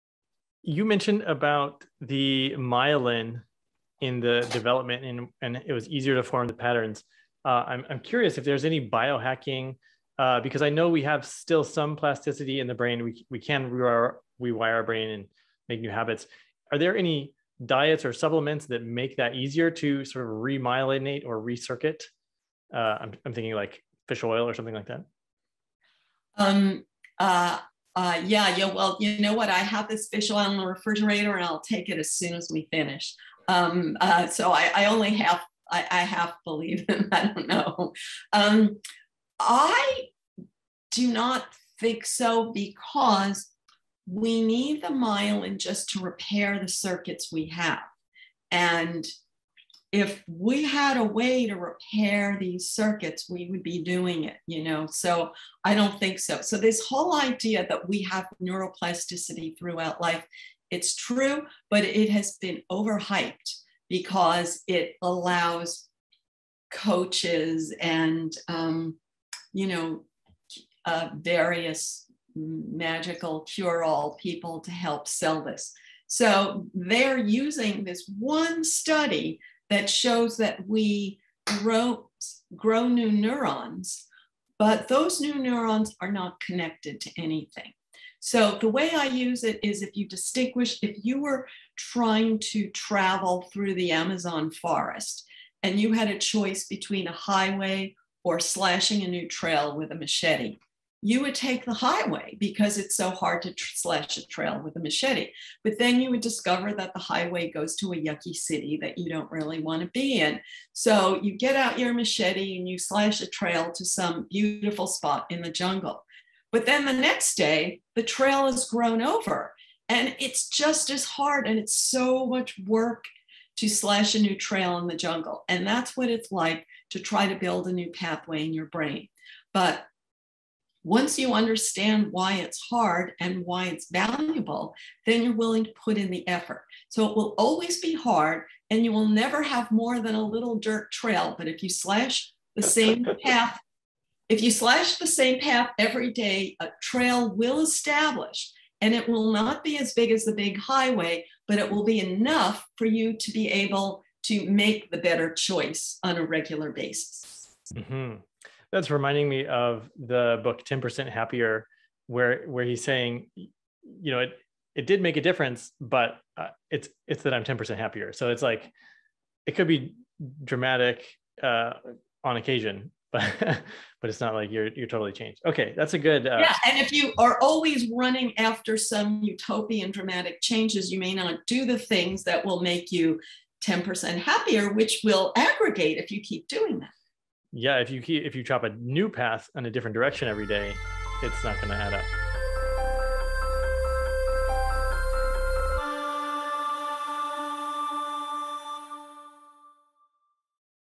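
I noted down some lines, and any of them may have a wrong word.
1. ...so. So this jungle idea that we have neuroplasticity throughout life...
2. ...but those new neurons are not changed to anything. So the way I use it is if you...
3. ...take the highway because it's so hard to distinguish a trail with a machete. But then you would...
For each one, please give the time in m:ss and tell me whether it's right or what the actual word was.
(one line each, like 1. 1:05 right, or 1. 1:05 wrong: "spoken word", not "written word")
1. 0:56 wrong: "whole", not "jungle"
2. 1:24 wrong: "connected", not "changed"
3. 1:41 wrong: "slash", not "distinguish".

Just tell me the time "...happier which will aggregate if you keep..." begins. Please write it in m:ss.
3:04.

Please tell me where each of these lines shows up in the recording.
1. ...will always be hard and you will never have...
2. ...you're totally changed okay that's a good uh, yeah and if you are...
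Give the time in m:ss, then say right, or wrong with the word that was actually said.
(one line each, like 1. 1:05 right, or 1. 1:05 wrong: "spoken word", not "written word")
1. 2:17 right
2. 2:54 right.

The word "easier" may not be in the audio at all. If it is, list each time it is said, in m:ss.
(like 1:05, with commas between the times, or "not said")
0:05, 0:19.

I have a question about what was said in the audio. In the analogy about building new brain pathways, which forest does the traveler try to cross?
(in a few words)
Amazon.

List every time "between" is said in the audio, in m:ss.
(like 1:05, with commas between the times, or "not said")
1:36.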